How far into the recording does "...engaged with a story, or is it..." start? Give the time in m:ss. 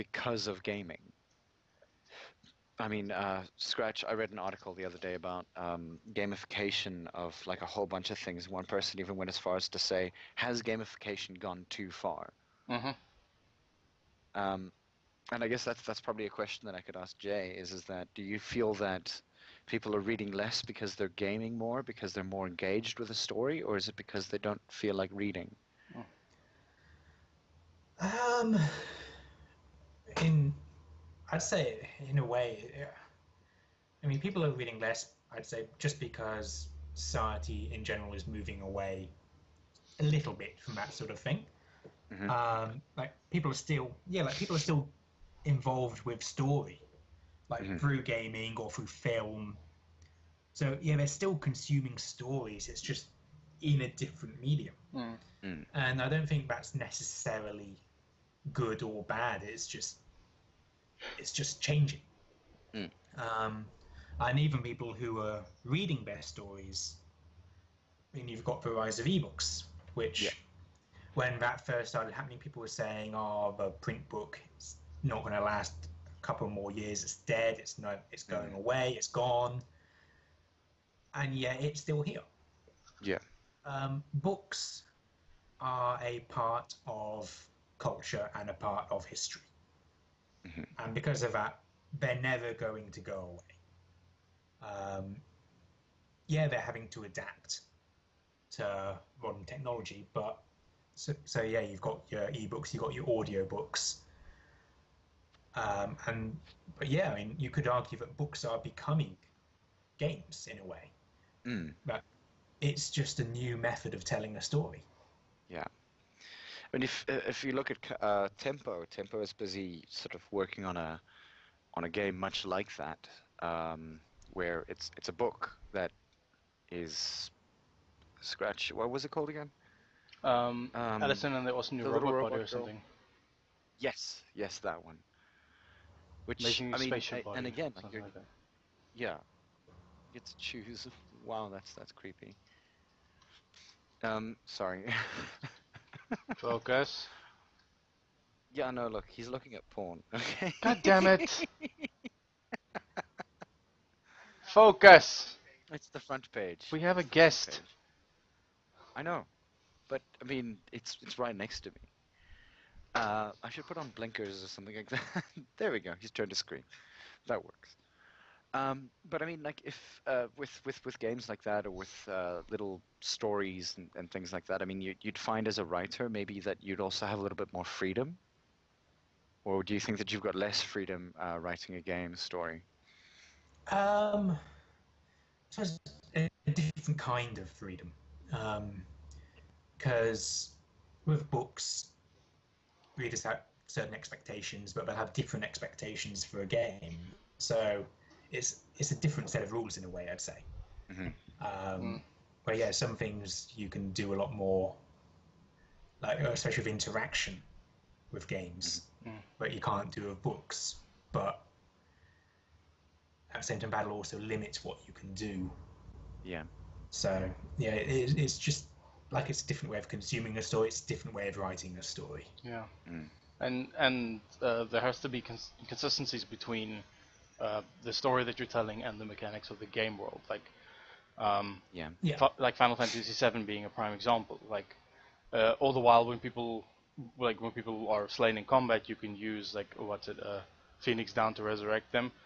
0:22.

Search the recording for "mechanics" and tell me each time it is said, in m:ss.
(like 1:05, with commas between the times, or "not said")
3:49.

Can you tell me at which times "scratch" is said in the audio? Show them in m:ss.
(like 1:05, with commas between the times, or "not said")
0:03, 2:08.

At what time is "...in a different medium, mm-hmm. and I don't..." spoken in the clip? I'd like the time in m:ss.
0:53.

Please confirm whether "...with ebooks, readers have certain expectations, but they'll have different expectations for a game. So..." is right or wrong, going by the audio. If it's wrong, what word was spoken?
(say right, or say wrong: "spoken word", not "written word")
wrong: "books", not "ebooks".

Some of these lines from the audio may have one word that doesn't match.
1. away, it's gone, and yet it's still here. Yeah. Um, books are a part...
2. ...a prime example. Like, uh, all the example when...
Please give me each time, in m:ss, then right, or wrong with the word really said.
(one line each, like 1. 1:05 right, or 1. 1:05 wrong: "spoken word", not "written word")
1. 1:18 right
2. 3:53 wrong: "while", not "example".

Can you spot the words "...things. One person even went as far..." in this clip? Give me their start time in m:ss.
0:08.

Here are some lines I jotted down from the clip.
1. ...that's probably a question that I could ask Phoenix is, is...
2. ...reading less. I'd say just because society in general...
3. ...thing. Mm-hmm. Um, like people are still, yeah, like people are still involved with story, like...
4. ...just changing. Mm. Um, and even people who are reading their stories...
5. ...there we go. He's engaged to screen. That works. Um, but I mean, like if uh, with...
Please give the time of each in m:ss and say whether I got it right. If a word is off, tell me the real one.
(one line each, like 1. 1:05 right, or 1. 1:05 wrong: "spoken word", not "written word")
1. 0:15 wrong: "Jay", not "Phoenix"
2. 0:34 right
3. 0:41 right
4. 1:01 right
5. 2:45 wrong: "turned", not "engaged".